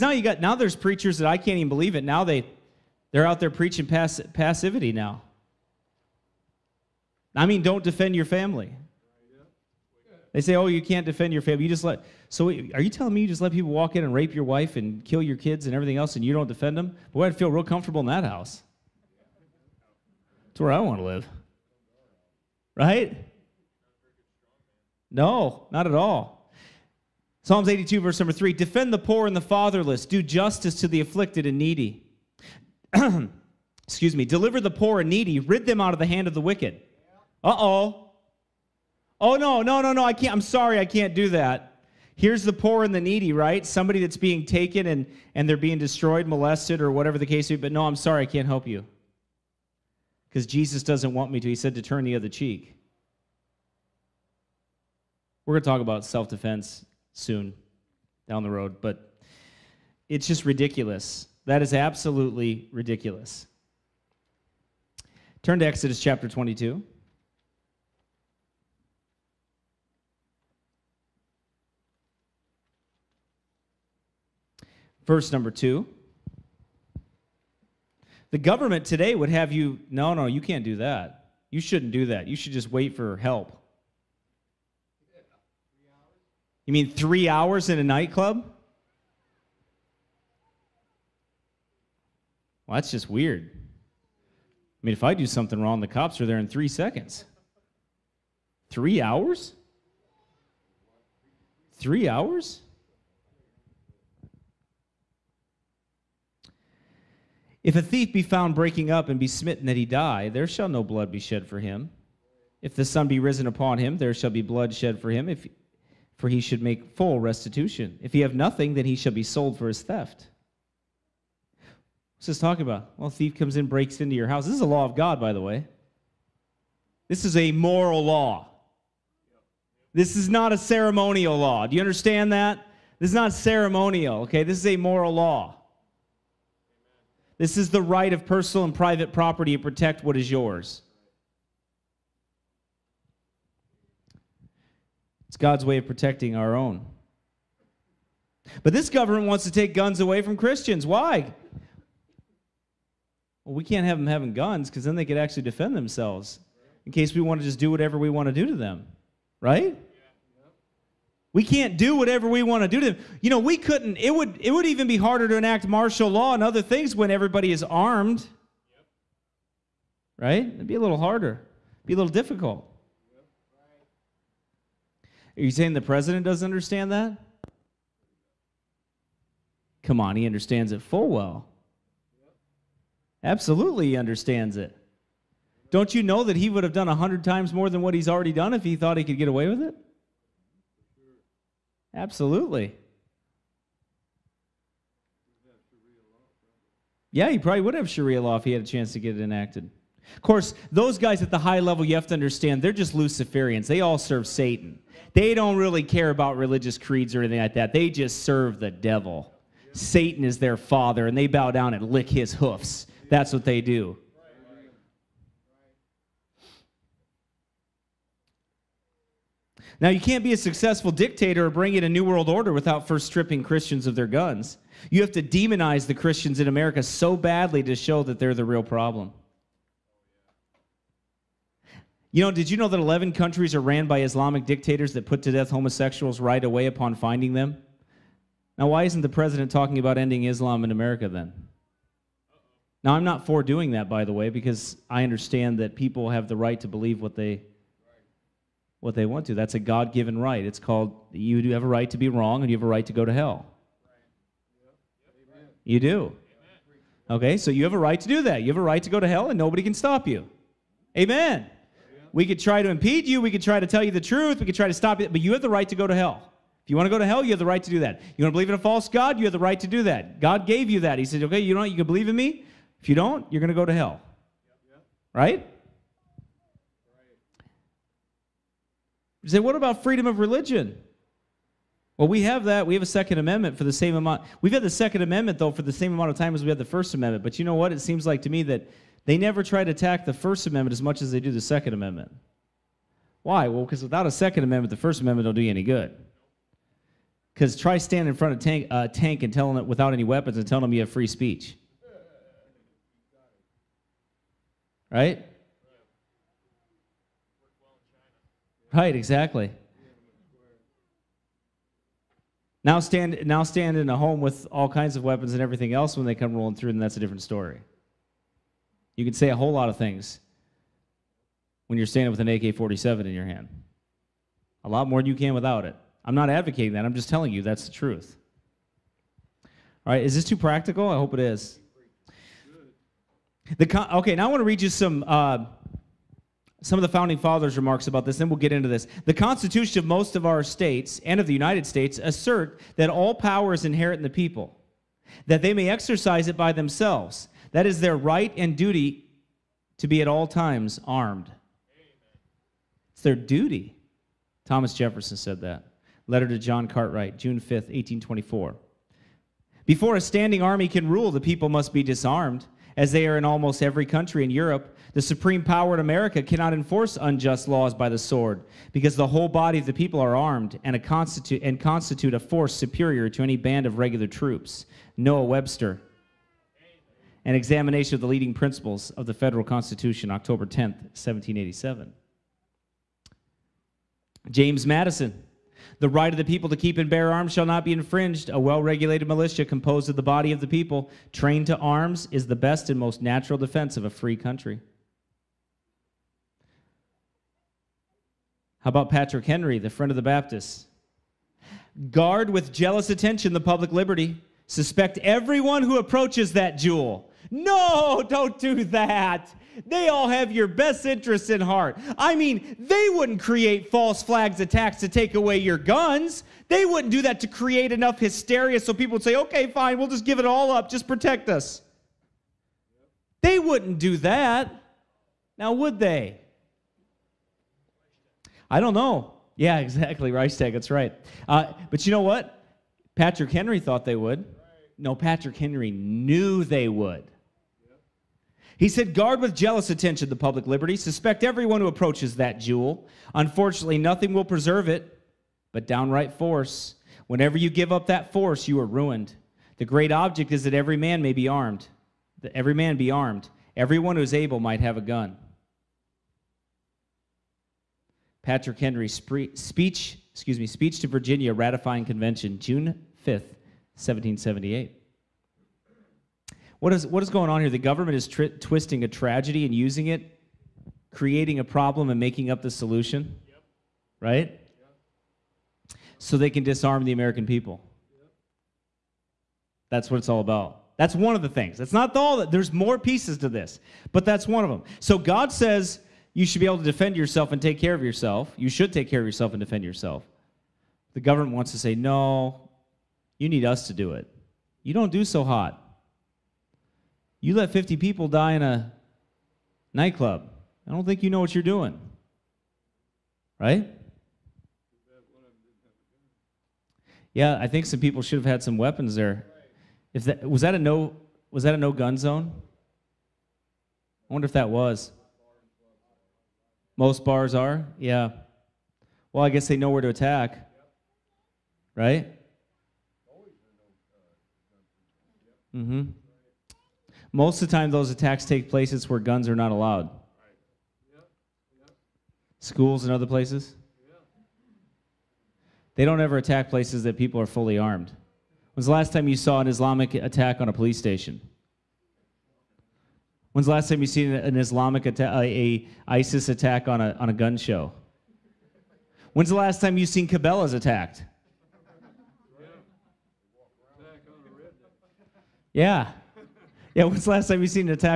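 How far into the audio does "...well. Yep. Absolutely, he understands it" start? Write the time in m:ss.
3:01.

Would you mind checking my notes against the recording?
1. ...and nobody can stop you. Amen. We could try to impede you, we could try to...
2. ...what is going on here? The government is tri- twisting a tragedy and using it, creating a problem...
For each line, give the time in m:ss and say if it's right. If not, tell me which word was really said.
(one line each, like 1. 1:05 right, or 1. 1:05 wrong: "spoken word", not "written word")
1. 4:19 right
2. 7:46 right.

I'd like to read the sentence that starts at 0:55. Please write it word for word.
We're going to talk about self defense soon down the road, but it's just ridiculous.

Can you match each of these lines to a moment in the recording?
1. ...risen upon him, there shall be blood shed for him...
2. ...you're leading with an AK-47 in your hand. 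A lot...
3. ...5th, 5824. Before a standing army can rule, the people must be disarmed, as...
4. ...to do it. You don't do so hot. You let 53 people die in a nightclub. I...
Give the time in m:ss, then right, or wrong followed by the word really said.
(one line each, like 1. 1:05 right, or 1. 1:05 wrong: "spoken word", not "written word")
1. 1:53 right
2. 5:21 wrong: "standing", not "leading"
3. 5:57 wrong: "1824", not "5824"
4. 8:13 wrong: "50", not "53".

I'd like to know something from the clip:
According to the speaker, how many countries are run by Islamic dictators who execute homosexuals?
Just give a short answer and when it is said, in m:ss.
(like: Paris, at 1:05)
11, at 3:52.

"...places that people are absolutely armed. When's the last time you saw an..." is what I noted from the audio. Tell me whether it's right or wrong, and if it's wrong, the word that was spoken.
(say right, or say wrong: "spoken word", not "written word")
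wrong: "fully", not "absolutely".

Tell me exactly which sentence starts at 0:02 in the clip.
Now they they're out there preaching pass, passivity now.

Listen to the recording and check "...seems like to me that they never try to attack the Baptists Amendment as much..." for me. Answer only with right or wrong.
wrong.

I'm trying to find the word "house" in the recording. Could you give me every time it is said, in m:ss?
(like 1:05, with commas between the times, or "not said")
0:18, 2:04.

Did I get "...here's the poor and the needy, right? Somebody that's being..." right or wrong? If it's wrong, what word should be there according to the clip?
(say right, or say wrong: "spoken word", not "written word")
right.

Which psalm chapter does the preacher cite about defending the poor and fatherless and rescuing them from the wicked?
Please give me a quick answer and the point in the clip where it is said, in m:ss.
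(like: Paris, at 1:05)
Psalms 82, at 0:27.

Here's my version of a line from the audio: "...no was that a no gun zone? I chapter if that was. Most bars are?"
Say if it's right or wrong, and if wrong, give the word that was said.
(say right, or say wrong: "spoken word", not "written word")
wrong: "wonder", not "chapter".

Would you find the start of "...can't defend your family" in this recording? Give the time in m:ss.
0:10.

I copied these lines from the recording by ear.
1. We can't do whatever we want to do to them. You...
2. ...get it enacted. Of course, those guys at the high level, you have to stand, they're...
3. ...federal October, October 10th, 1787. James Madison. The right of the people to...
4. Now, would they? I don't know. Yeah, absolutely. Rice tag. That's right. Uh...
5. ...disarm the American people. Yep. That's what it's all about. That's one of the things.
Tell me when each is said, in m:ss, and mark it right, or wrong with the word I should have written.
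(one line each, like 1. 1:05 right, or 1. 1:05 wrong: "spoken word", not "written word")
1. 2:41 right
2. 3:18 wrong: "understand", not "stand"
3. 6:19 wrong: "Constitution", not "October"
4. 7:05 wrong: "exactly", not "absolutely"
5. 7:56 right.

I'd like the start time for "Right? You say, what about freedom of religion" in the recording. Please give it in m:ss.
4:35.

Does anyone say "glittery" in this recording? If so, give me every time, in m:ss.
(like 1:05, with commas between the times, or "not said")
not said.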